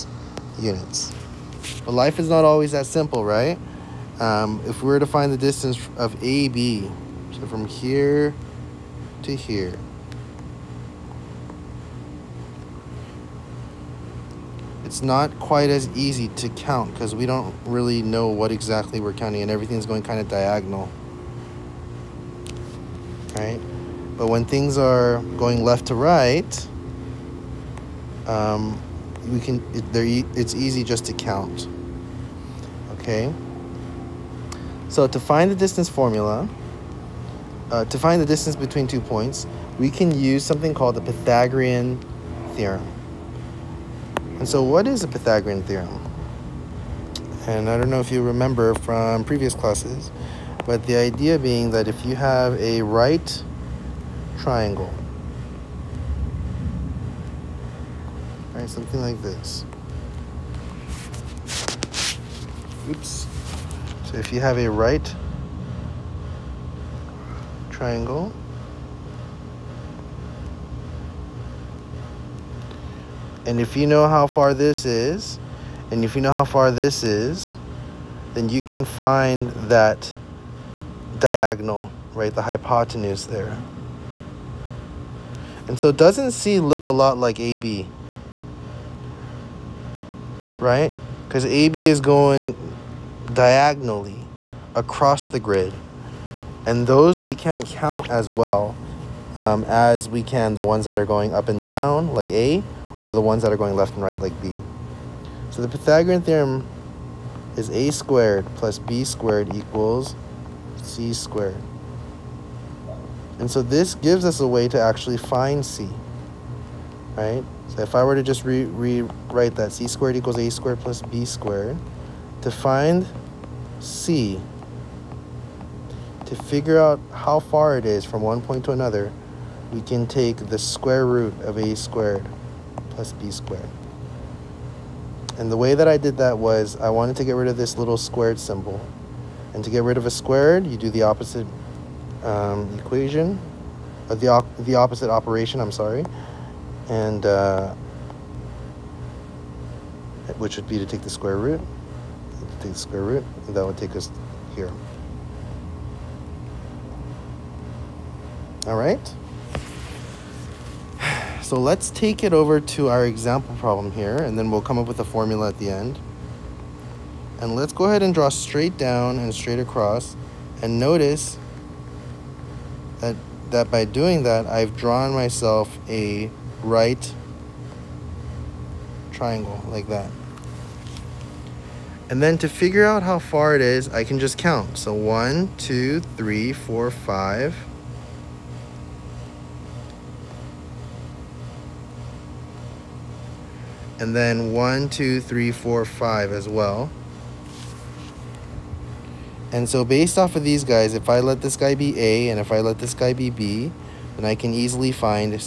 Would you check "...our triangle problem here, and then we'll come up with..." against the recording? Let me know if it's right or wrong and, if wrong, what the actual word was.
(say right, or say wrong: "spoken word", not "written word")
wrong: "example", not "triangle".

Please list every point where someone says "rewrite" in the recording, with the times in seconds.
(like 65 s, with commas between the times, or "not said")
118 s.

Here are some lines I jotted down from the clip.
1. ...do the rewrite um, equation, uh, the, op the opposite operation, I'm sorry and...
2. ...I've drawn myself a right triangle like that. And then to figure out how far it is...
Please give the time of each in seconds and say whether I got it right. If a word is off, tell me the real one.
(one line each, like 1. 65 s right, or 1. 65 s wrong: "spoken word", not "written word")
1. 140 s wrong: "opposite", not "rewrite"
2. 174 s right.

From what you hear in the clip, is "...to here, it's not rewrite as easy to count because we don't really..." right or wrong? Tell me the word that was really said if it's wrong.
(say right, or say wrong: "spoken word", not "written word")
wrong: "quite", not "rewrite".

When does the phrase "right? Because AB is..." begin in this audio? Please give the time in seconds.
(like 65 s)
90 s.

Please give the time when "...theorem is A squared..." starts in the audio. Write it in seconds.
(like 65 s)
106 s.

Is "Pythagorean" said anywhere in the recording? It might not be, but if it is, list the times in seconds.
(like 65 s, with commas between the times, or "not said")
41 s, 45 s, 105 s.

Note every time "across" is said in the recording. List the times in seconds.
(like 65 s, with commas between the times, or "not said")
94 s, 169 s.